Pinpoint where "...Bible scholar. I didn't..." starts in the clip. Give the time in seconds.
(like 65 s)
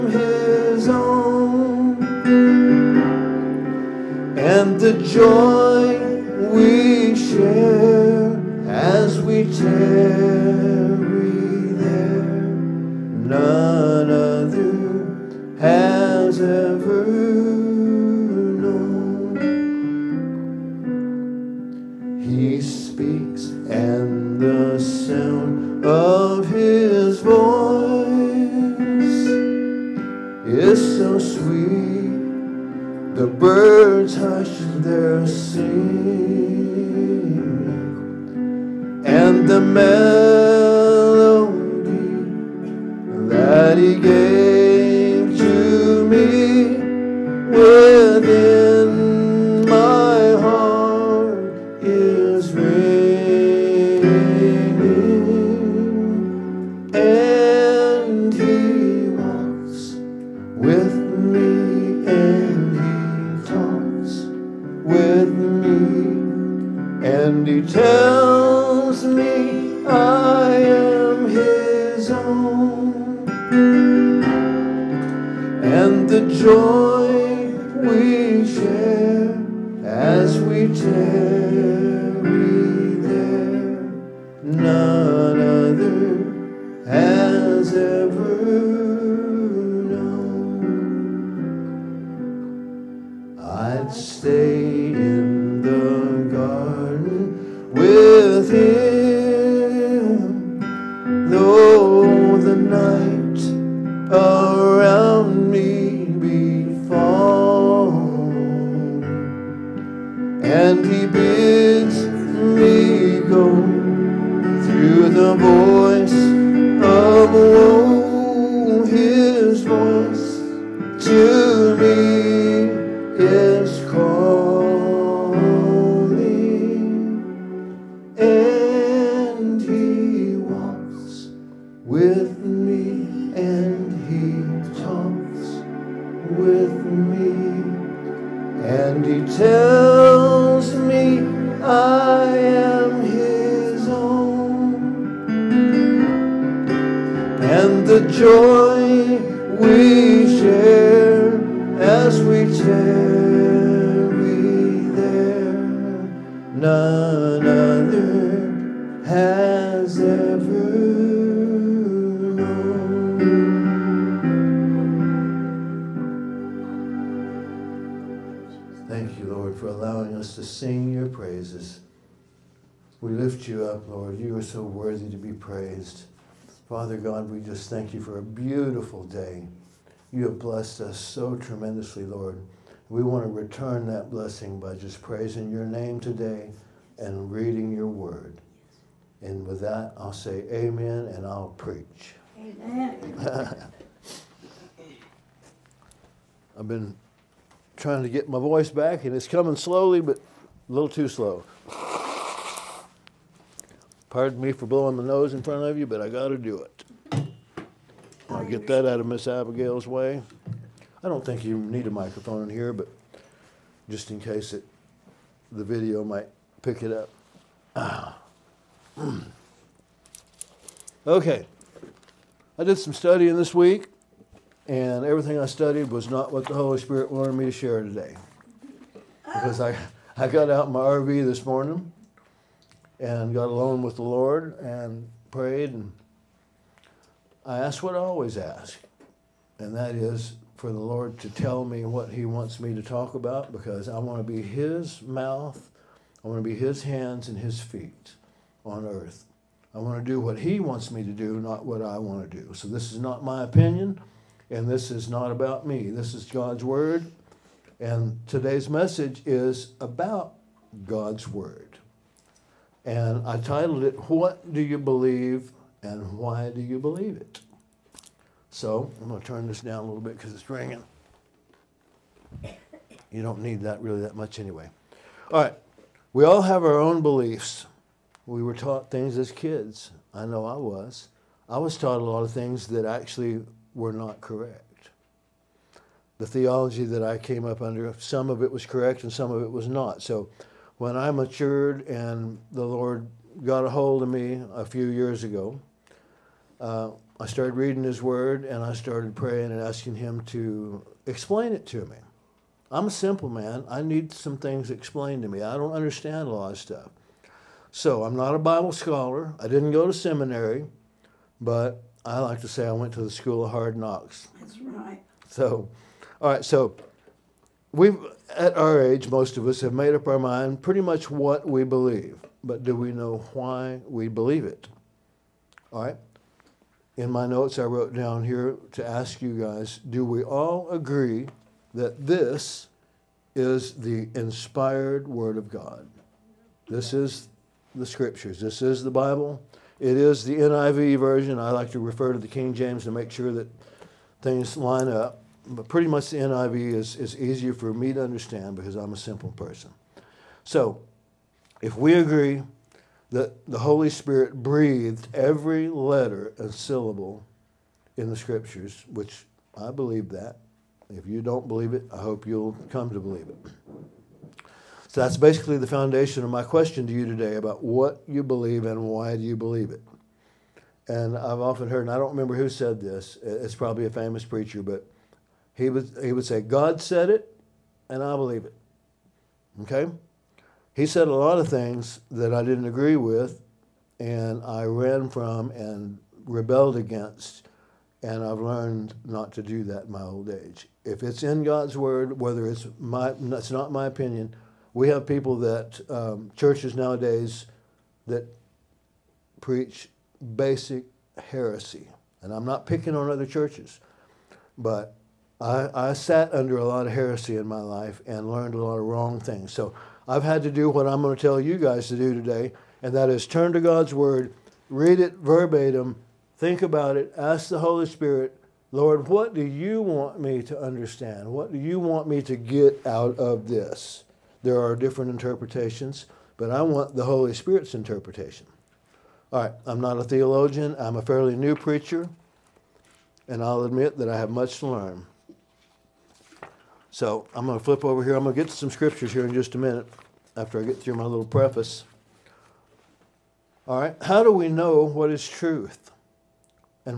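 308 s.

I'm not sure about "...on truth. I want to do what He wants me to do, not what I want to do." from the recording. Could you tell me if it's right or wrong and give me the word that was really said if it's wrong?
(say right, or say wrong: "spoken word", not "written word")
wrong: "earth", not "truth".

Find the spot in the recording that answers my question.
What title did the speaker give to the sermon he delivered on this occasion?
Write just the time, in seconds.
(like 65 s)
264 s.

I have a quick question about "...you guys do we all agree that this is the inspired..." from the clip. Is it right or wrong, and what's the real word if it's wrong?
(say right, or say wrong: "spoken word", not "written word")
right.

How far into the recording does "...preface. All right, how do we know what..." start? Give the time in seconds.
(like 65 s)
441 s.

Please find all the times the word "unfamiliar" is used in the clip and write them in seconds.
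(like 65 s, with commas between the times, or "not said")
not said.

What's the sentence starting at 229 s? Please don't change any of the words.
Because I, I got out in my RV this morning and got alone with the Lord and prayed.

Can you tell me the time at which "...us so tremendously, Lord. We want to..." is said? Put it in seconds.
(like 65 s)
180 s.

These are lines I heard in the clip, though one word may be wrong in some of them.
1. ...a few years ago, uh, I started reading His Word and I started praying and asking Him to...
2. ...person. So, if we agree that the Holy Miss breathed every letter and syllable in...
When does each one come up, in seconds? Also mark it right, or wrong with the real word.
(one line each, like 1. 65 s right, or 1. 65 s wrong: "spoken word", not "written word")
1. 294 s right
2. 349 s wrong: "Spirit", not "Miss".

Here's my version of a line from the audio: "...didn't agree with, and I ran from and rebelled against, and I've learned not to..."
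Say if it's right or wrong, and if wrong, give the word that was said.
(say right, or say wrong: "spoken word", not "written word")
right.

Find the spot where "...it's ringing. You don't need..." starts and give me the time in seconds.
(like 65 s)
270 s.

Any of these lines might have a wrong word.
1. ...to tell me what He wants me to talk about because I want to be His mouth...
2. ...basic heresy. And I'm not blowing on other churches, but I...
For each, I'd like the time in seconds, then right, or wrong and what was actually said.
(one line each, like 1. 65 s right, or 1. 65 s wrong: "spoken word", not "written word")
1. 241 s right
2. 400 s wrong: "picking", not "blowing".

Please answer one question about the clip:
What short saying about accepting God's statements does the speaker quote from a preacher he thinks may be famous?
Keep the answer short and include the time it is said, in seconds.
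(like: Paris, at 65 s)
God said it, and I believe it, at 376 s.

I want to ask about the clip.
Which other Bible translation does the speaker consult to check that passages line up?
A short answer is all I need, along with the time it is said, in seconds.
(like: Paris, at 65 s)
King James, at 342 s.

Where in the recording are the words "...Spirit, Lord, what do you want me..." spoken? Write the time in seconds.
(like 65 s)
417 s.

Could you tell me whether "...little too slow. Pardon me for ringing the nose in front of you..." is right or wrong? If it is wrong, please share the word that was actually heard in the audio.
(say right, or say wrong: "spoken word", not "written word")
wrong: "blowing", not "ringing".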